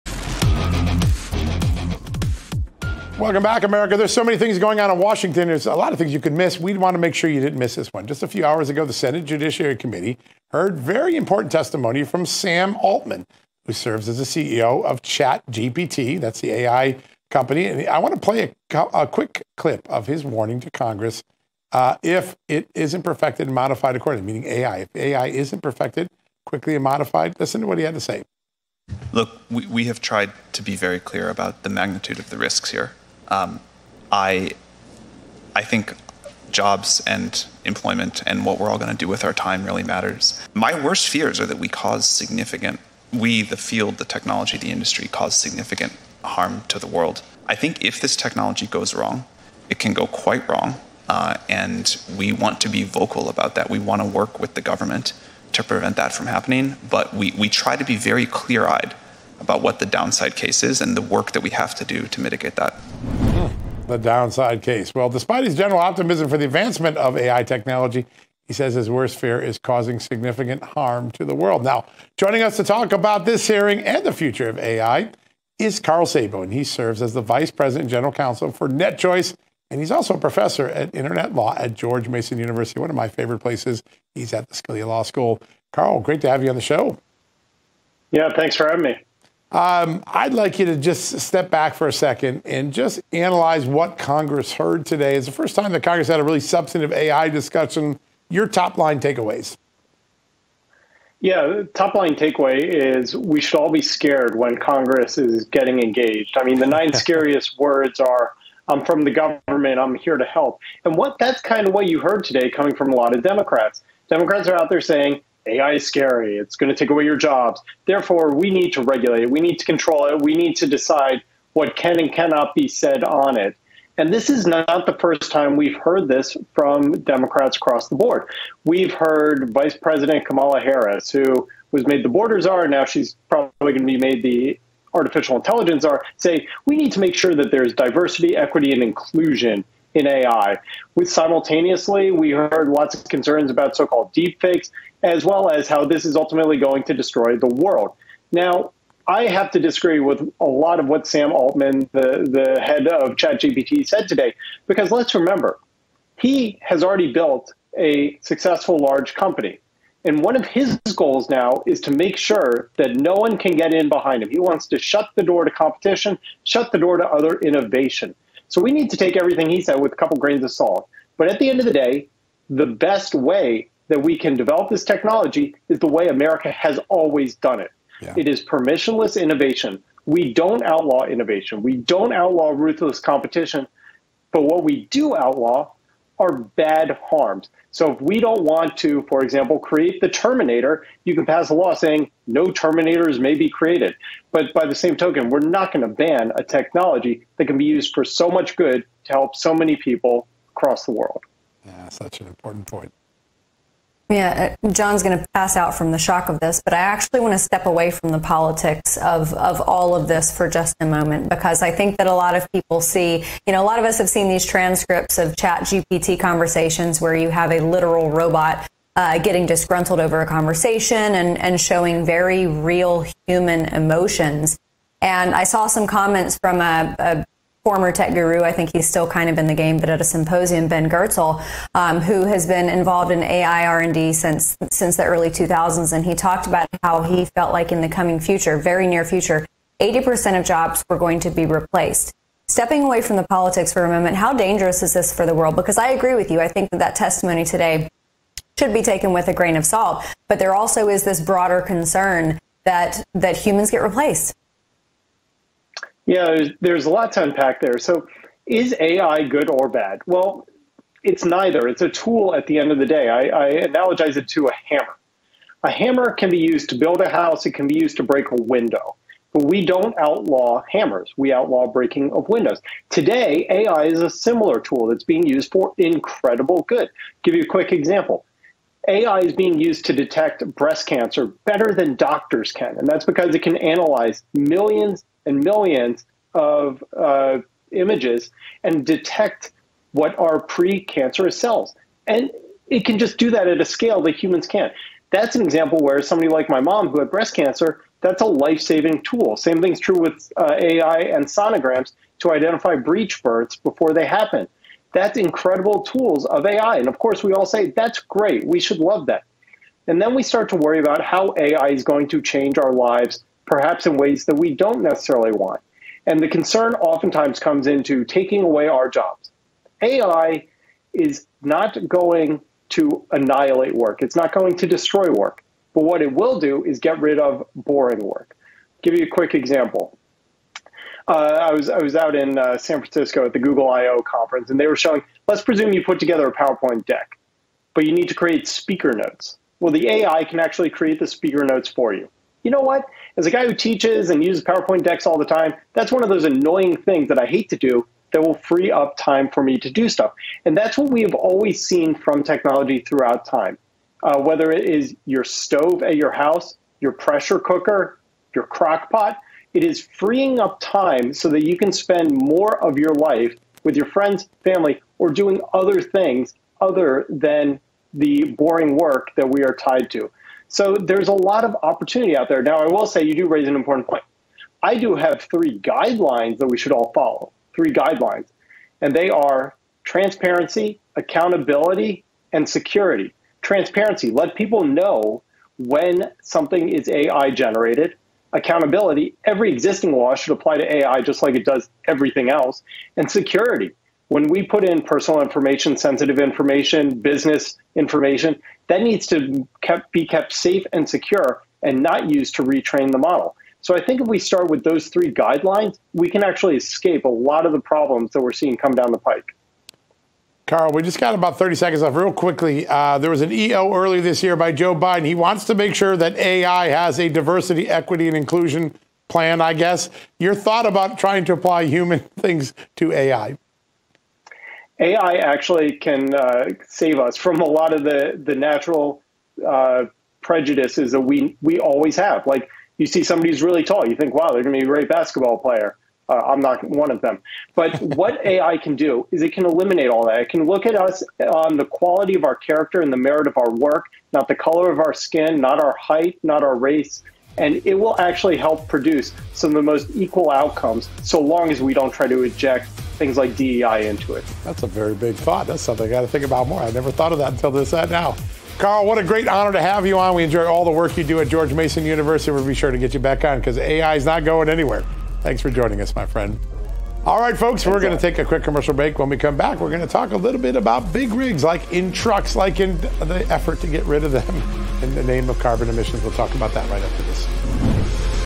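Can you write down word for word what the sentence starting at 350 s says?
And that's what we have always seen from technology throughout time.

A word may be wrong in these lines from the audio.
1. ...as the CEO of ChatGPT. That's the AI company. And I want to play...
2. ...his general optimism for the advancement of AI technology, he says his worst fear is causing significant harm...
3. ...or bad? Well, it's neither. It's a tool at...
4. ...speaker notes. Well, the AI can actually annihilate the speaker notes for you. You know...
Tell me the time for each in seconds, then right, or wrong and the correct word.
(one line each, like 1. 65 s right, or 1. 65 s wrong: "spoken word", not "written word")
1. 14 s right
2. 65 s right
3. 259 s right
4. 338 s wrong: "create", not "annihilate".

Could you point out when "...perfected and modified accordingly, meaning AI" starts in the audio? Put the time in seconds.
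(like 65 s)
23 s.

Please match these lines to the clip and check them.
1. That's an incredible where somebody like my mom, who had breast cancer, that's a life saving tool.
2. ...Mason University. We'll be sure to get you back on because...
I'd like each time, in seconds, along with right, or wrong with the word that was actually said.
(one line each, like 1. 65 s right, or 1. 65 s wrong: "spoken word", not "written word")
1. 295 s wrong: "example", not "incredible"
2. 461 s right.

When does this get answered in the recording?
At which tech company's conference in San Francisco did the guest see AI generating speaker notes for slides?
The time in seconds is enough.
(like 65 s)
333 s.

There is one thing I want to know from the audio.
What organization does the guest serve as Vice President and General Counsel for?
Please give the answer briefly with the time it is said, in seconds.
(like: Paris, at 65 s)
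NetChoice, at 78 s.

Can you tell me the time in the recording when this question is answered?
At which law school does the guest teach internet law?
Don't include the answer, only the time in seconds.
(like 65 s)
84 s.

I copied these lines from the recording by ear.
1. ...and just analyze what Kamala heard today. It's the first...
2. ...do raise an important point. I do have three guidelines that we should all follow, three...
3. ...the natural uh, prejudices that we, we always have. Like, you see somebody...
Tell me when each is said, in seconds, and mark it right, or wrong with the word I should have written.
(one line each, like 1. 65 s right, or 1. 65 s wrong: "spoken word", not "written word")
1. 92 s wrong: "Congress", not "Kamala"
2. 373 s right
3. 428 s right.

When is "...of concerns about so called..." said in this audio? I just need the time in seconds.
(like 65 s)
142 s.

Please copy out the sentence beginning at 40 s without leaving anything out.
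My worst fears are that we cause significant, we, the field, the technology, the industry, cause significant harm to the world.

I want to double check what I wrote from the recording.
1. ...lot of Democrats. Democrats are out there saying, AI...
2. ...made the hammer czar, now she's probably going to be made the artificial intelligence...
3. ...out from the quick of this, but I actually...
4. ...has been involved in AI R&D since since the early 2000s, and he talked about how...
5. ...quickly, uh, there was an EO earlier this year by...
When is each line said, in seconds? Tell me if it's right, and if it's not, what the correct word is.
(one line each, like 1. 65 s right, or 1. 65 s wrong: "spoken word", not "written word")
1. 112 s right
2. 131 s wrong: "border", not "hammer"
3. 205 s wrong: "shock", not "quick"
4. 232 s right
5. 412 s right.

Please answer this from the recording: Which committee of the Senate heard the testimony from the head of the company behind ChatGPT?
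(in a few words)
Judiciary Committee.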